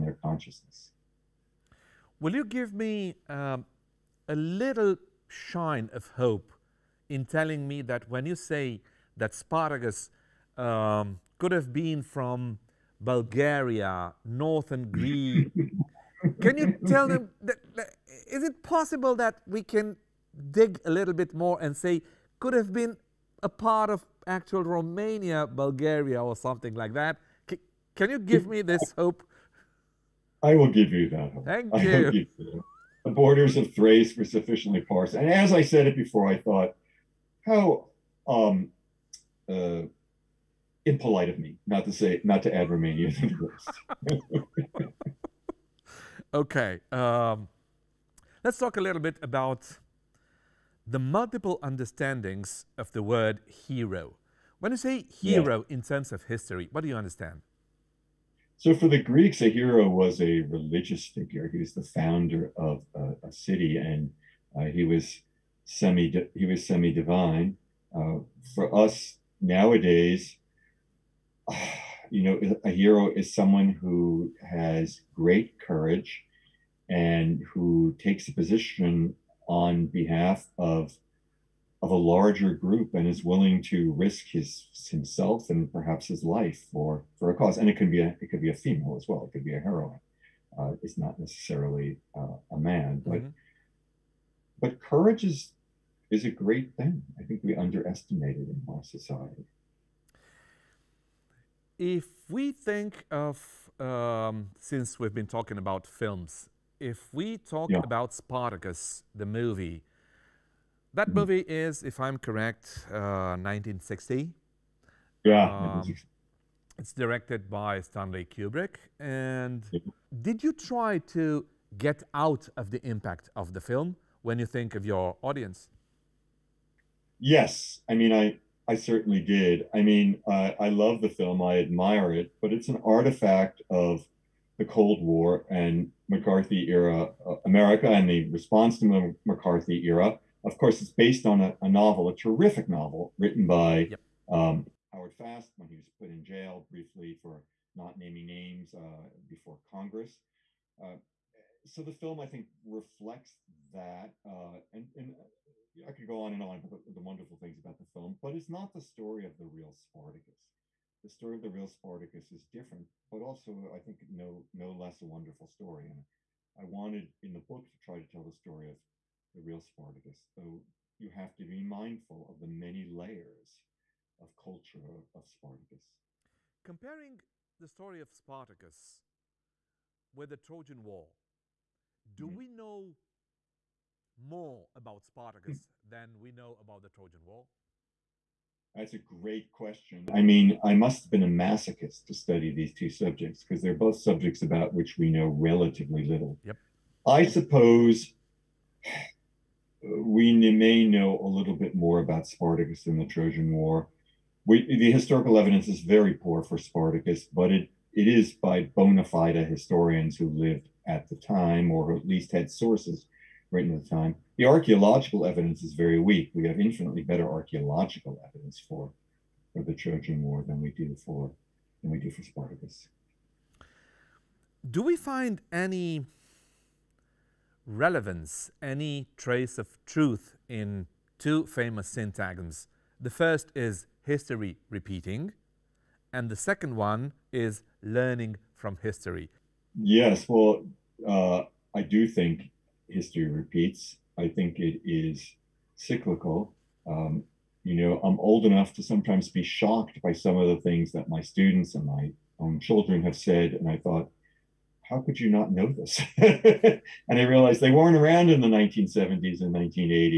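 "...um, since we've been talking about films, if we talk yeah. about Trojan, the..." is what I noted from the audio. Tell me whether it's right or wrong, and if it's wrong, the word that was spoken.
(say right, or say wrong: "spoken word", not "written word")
wrong: "Spartacus", not "Trojan".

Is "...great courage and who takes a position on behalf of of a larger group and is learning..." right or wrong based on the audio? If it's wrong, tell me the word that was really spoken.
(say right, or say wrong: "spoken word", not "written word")
wrong: "willing", not "learning".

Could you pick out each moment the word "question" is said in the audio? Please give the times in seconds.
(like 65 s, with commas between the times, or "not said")
189 s.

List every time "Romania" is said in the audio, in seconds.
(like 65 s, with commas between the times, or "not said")
24 s, 42 s.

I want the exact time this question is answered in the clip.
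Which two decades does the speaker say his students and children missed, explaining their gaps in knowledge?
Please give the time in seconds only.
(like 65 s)
258 s.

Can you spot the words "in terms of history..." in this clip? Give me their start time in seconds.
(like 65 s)
55 s.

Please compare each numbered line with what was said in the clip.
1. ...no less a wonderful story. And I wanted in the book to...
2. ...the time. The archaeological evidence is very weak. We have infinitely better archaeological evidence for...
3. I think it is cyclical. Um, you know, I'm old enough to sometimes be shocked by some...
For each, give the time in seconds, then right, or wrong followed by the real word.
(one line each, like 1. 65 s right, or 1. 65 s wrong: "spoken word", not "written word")
1. 164 s right
2. 213 s right
3. 244 s right.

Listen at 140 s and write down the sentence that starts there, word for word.
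Of course, it's based on a, a novel, a terrific novel written by yep.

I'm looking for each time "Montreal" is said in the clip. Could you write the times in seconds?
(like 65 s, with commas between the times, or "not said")
not said.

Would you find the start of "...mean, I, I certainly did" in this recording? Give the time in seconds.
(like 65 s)
127 s.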